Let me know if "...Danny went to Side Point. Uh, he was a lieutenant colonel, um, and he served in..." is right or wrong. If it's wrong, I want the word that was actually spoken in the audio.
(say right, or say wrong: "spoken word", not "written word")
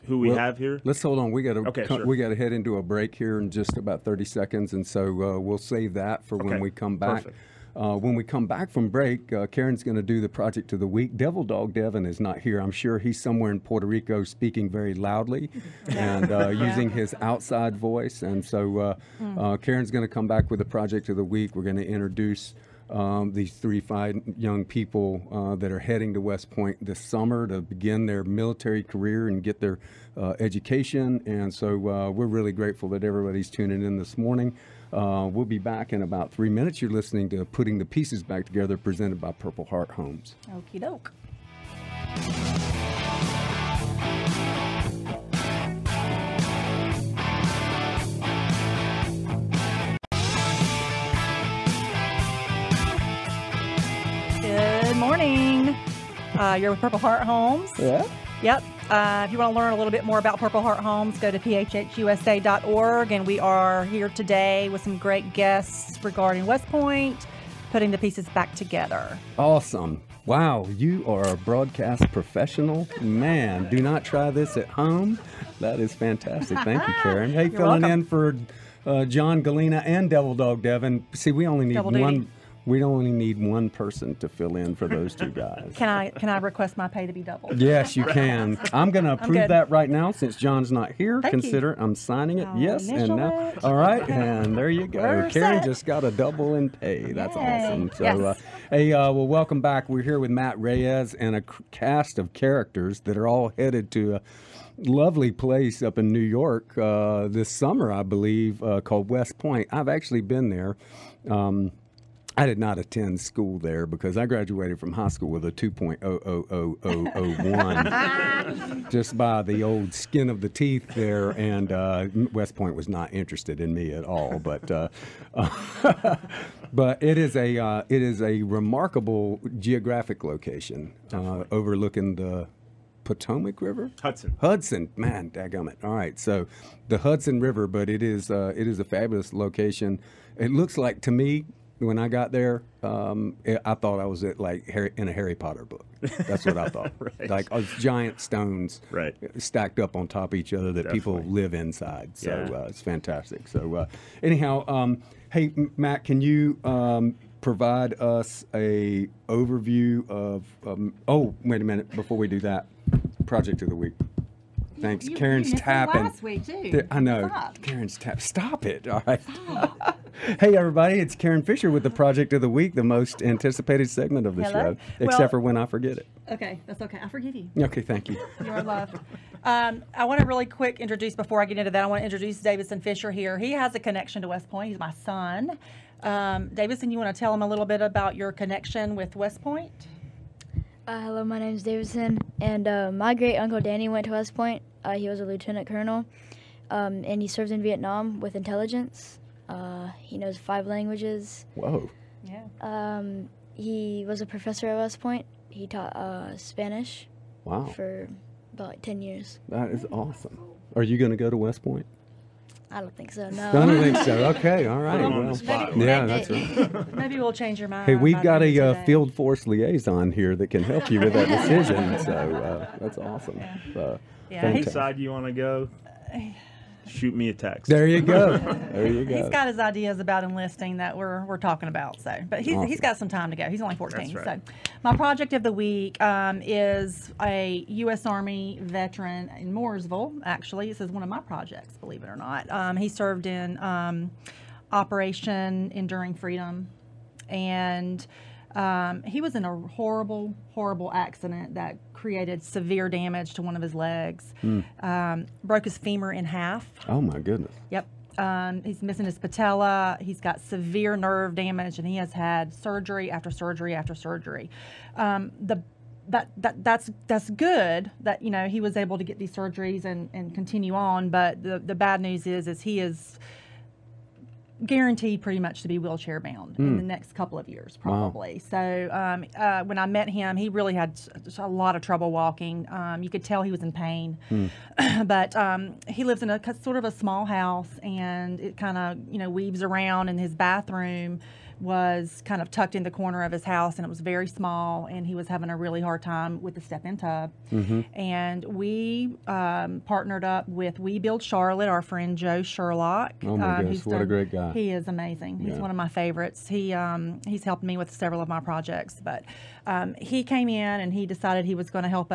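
wrong: "West", not "Side".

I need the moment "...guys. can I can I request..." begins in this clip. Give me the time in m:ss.
1:25.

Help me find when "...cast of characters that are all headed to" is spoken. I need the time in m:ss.
1:41.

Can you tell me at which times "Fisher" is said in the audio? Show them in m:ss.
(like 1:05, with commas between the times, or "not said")
2:51, 3:02.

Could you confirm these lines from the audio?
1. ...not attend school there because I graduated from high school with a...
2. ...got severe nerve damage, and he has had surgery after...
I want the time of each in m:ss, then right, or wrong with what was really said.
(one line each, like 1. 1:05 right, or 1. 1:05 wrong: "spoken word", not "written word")
1. 1:52 right
2. 4:20 right.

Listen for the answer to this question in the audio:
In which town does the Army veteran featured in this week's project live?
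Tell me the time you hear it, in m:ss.
3:59.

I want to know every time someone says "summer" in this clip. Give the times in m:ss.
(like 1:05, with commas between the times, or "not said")
0:26, 1:47.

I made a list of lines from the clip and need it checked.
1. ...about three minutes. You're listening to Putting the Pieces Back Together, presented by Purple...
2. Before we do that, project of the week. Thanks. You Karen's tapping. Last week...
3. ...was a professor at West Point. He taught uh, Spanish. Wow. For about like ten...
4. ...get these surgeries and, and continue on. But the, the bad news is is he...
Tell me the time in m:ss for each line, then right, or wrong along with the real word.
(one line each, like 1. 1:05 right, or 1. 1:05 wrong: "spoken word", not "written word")
1. 0:36 right
2. 2:41 right
3. 3:24 right
4. 4:29 right.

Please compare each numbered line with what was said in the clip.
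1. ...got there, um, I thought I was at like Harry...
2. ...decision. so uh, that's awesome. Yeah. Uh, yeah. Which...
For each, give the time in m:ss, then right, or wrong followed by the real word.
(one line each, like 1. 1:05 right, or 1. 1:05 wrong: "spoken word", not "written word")
1. 2:22 right
2. 3:41 right.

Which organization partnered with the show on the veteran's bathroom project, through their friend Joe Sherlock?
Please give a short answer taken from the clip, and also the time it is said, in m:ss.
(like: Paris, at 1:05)
We Build Charlotte, at 5:00.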